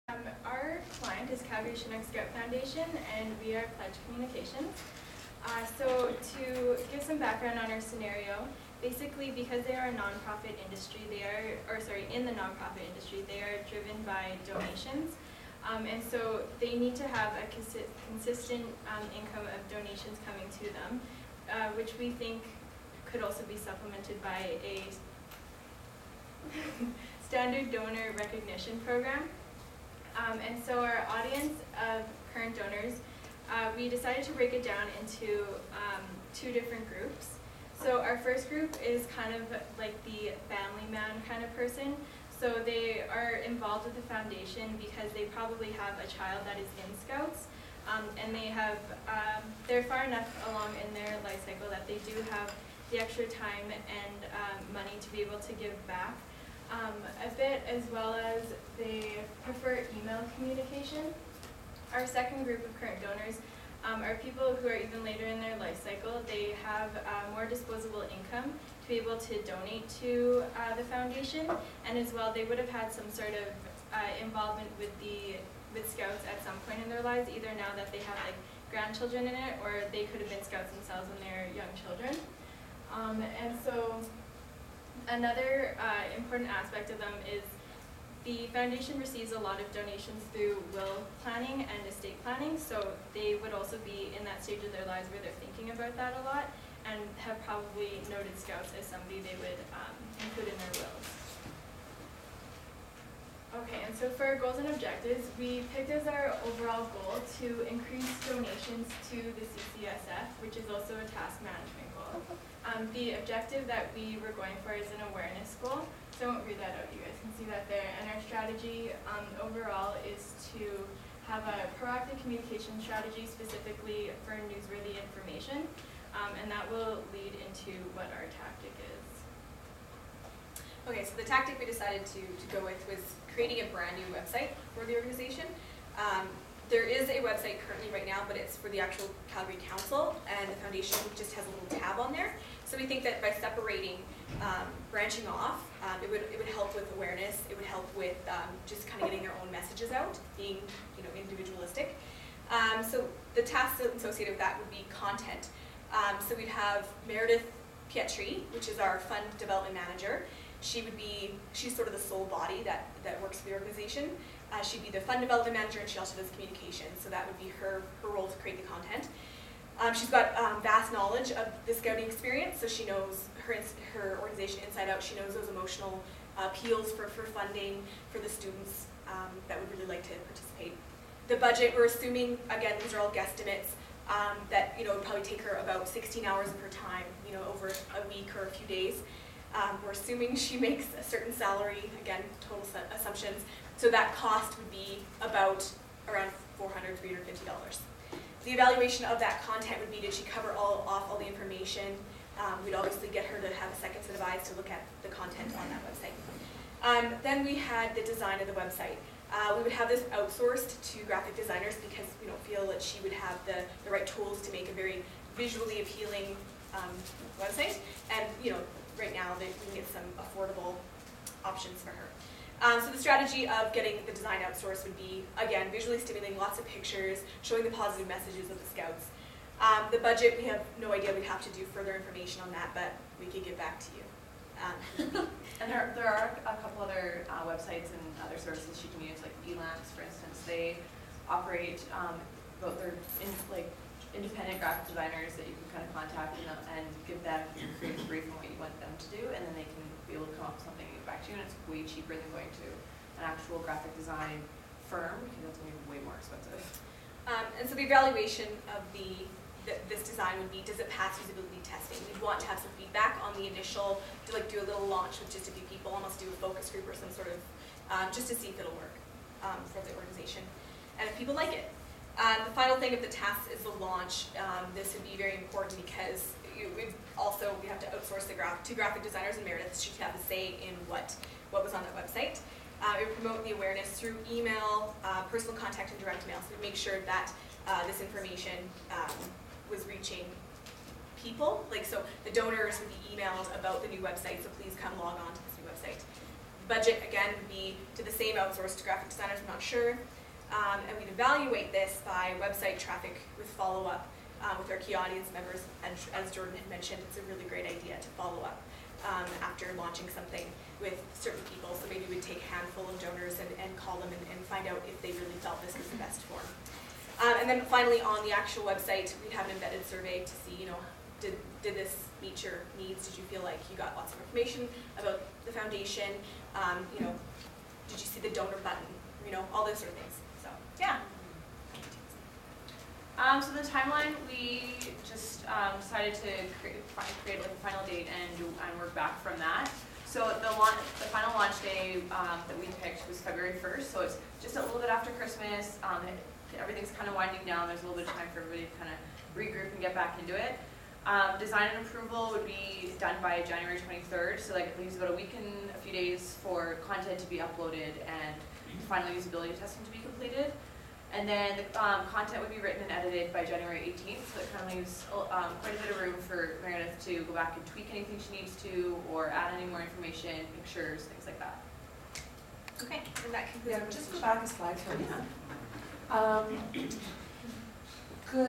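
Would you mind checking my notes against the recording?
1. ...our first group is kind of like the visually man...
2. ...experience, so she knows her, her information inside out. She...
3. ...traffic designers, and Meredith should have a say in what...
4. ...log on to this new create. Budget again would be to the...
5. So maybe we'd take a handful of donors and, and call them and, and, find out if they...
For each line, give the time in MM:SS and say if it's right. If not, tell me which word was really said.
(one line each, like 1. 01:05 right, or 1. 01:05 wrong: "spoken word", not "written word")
1. 00:38 wrong: "family", not "visually"
2. 02:52 wrong: "organization", not "information"
3. 04:38 wrong: "graphic", not "traffic"
4. 04:54 wrong: "website", not "create"
5. 05:11 right.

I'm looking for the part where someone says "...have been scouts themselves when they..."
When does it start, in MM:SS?
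01:20.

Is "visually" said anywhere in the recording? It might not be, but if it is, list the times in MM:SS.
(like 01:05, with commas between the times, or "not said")
03:35, 03:45.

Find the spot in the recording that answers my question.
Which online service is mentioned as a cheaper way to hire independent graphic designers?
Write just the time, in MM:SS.
03:59.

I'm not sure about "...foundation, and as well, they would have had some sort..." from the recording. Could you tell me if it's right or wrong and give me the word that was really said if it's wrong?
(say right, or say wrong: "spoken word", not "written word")
right.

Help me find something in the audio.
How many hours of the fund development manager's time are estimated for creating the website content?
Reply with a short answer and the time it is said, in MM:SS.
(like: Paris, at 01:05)
16, at 03:05.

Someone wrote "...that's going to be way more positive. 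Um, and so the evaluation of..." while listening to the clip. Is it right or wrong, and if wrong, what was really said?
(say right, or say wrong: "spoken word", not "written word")
wrong: "expensive", not "positive".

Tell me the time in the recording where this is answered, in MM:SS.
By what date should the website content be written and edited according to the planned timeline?
06:03.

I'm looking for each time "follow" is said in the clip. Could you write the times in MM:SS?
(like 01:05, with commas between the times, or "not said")
05:03, 05:08.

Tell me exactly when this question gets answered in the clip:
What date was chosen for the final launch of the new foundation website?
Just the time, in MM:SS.
05:43.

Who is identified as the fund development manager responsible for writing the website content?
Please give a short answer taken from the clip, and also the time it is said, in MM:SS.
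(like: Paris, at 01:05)
Meredith Pietri, at 02:37.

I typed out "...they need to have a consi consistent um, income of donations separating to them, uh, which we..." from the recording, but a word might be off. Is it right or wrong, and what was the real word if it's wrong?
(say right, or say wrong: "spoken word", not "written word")
wrong: "coming", not "separating".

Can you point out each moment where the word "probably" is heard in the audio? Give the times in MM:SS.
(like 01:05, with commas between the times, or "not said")
00:45, 01:37, 03:05.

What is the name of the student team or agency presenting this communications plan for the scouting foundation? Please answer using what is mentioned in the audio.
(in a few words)
Pledge Communications.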